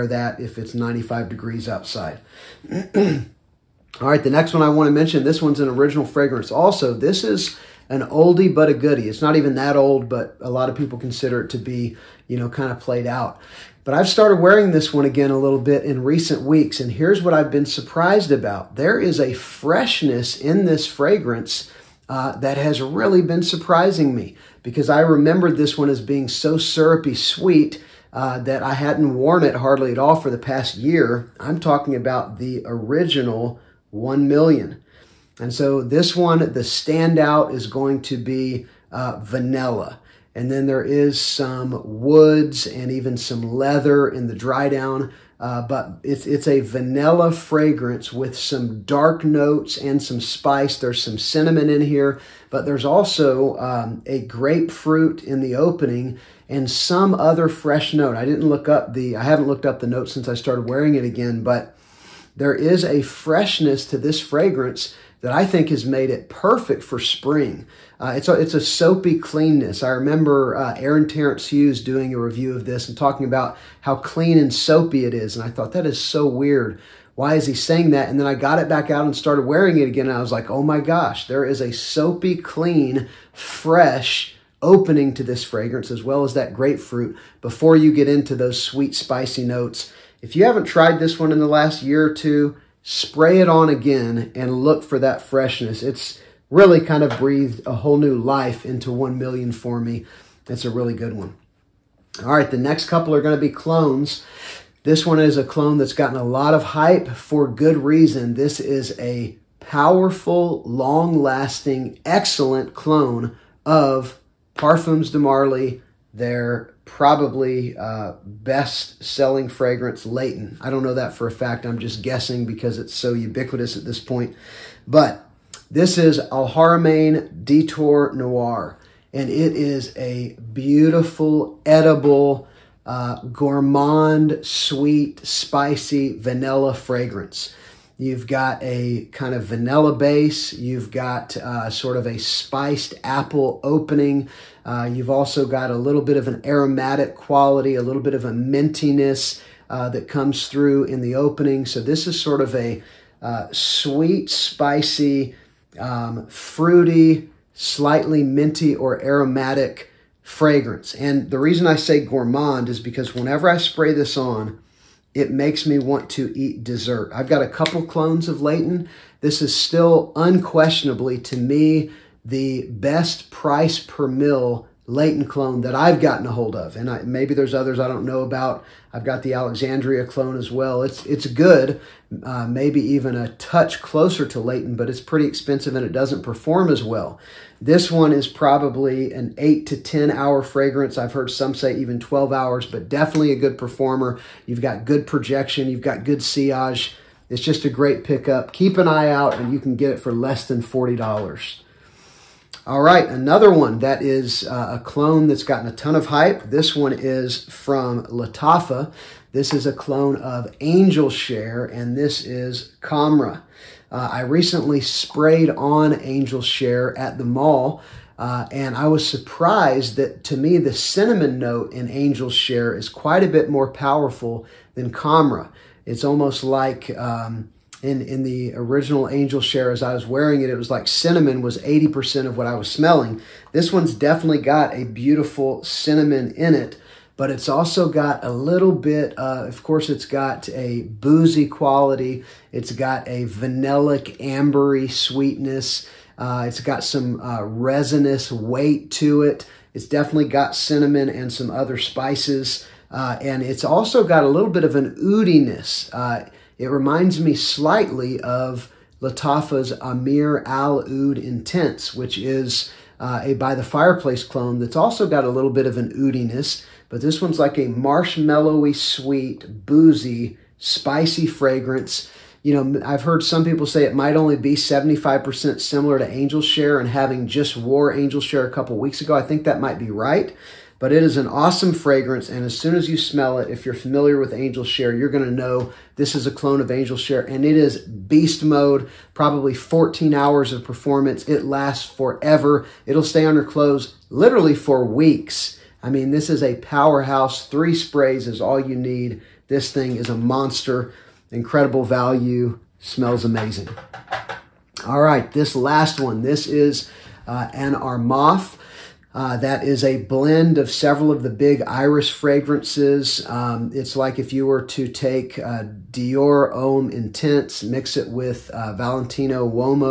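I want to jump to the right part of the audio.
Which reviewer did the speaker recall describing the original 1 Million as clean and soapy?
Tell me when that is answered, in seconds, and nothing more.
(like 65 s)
70 s.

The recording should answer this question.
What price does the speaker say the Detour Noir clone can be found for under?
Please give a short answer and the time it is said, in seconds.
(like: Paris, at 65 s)
40 dollars, at 200 s.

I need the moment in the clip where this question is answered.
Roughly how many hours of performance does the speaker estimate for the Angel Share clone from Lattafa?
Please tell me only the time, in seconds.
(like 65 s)
289 s.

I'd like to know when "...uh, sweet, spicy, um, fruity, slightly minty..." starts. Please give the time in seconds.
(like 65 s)
153 s.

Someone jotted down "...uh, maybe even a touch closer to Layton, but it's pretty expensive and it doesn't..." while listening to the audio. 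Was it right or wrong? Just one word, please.
right.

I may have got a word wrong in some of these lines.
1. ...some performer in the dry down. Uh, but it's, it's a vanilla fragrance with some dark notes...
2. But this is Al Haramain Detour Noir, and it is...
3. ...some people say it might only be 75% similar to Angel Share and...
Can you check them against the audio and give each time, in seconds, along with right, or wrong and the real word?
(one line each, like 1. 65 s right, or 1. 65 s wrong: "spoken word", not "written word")
1. 43 s wrong: "leather", not "performer"
2. 124 s right
3. 273 s right.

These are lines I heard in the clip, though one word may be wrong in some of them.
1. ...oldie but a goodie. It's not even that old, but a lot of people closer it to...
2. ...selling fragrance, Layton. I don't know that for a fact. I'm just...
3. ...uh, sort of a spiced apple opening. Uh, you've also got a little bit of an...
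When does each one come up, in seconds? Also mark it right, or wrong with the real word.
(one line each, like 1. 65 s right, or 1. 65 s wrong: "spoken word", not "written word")
1. 8 s wrong: "consider", not "closer"
2. 119 s right
3. 141 s right.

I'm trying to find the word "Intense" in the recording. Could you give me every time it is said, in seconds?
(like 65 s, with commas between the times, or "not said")
261 s, 316 s.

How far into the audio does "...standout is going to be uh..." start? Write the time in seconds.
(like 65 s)
36 s.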